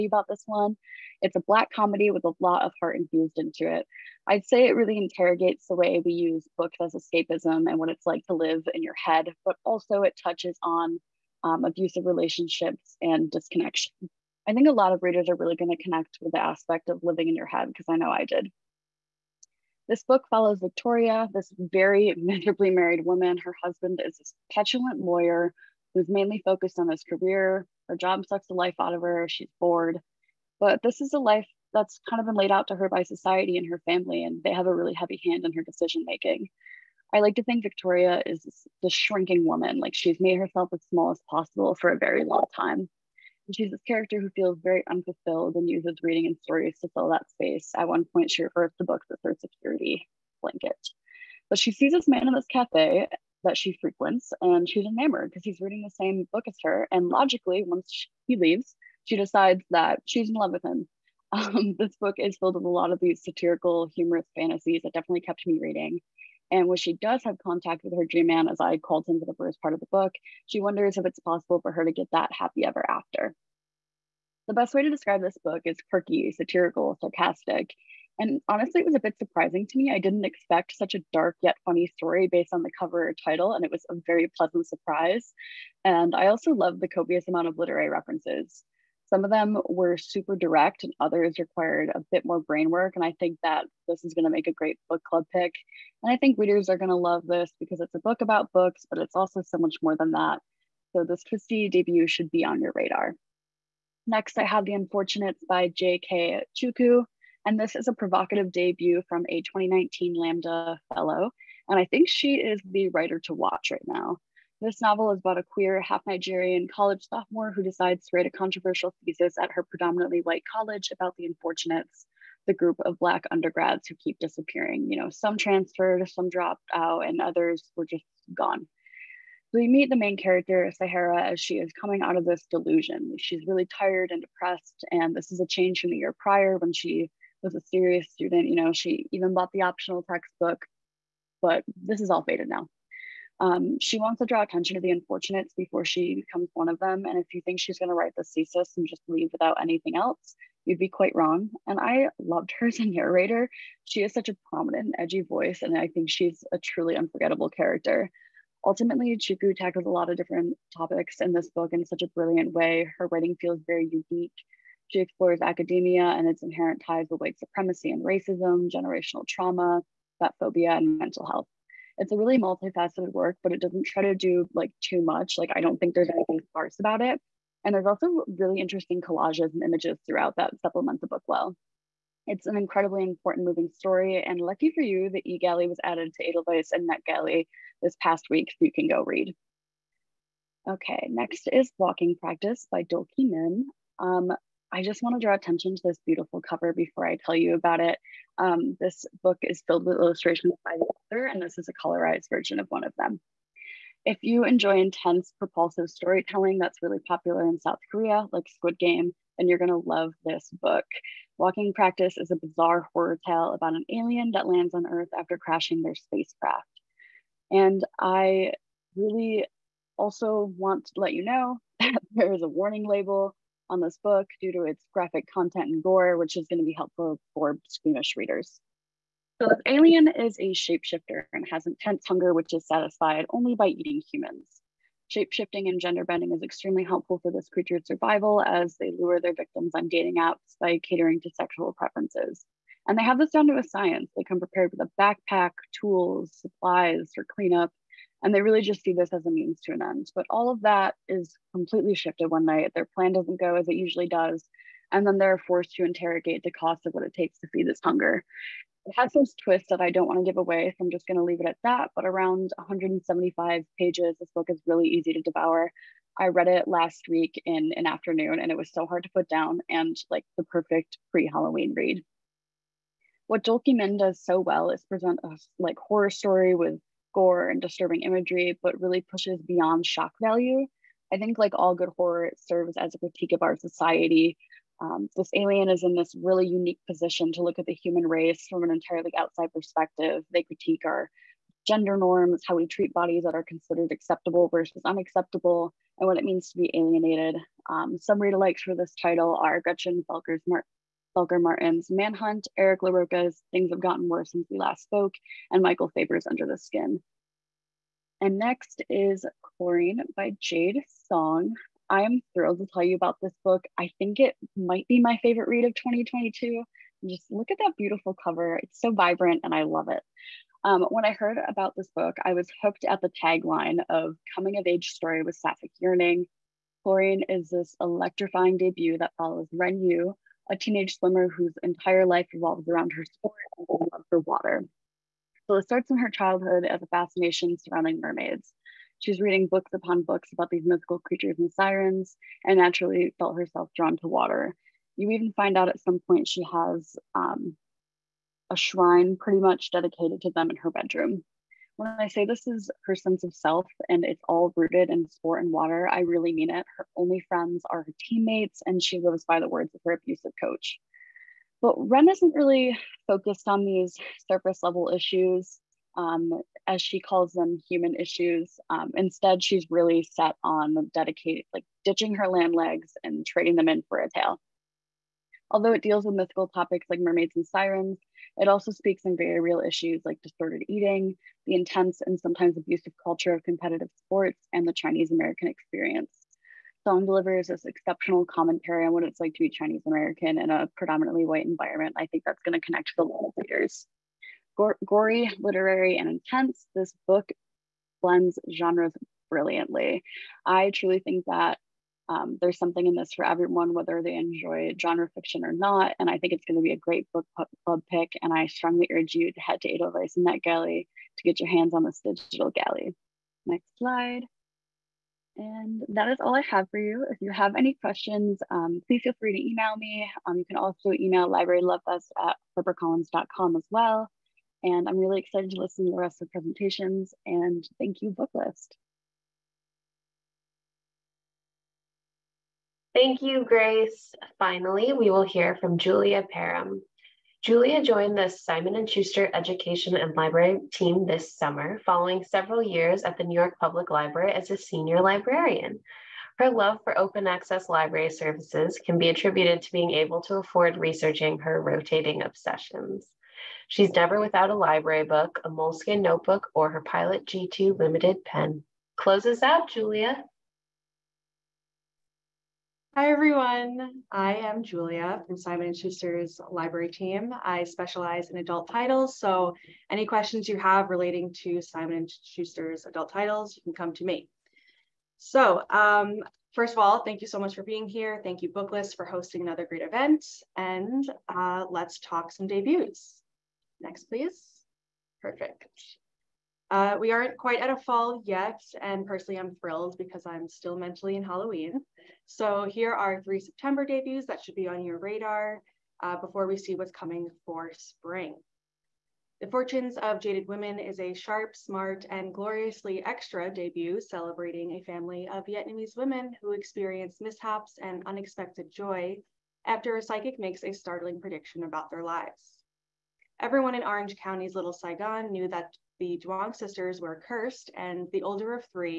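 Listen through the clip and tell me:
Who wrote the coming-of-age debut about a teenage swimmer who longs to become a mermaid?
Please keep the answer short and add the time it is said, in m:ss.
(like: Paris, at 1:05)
Jade Song, at 5:10.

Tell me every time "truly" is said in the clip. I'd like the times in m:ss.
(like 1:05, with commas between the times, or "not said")
2:36, 6:40.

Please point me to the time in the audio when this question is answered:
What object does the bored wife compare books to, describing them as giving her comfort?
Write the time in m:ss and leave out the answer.
0:49.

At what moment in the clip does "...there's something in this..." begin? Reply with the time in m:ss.
6:42.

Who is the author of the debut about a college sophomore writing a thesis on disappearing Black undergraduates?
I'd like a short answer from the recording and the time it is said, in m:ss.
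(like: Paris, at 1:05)
J.K. Chukwu, at 1:45.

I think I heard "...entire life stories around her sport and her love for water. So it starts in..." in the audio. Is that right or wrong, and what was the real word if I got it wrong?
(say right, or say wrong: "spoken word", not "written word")
wrong: "revolves", not "stories".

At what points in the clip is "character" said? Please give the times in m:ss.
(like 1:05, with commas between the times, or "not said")
0:43, 2:10, 2:37.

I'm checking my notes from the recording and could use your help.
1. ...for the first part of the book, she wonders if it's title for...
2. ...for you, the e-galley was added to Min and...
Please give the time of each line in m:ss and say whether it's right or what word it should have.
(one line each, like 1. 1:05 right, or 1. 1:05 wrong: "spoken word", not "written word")
1. 1:09 wrong: "possible", not "title"
2. 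3:04 wrong: "Edelweiss", not "Min".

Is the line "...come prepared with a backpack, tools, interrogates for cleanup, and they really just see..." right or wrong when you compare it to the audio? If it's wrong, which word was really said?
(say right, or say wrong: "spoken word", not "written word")
wrong: "supplies", not "interrogates".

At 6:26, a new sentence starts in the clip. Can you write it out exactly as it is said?
Song delivers this exceptional commentary on what it's like to be Chinese American in a predominantly white environment.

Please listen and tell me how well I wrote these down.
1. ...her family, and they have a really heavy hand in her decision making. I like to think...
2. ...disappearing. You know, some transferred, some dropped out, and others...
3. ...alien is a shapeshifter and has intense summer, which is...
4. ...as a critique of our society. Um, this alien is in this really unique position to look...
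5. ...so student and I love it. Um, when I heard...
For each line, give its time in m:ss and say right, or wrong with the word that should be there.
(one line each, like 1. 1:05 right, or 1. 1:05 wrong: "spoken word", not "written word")
1. 0:33 right
2. 2:04 right
3. 3:49 wrong: "hunger", not "summer"
4. 4:42 right
5. 5:18 wrong: "vibrant", not "student".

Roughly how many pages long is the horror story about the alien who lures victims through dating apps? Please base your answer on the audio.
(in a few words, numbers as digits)
175.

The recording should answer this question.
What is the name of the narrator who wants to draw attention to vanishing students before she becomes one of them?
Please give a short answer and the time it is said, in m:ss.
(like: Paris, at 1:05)
Sahara, at 2:10.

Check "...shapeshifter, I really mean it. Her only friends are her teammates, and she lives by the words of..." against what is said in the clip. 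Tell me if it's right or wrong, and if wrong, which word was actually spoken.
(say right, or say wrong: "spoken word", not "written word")
wrong: "water", not "shapeshifter".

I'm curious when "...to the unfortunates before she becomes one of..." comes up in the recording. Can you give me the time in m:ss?
2:24.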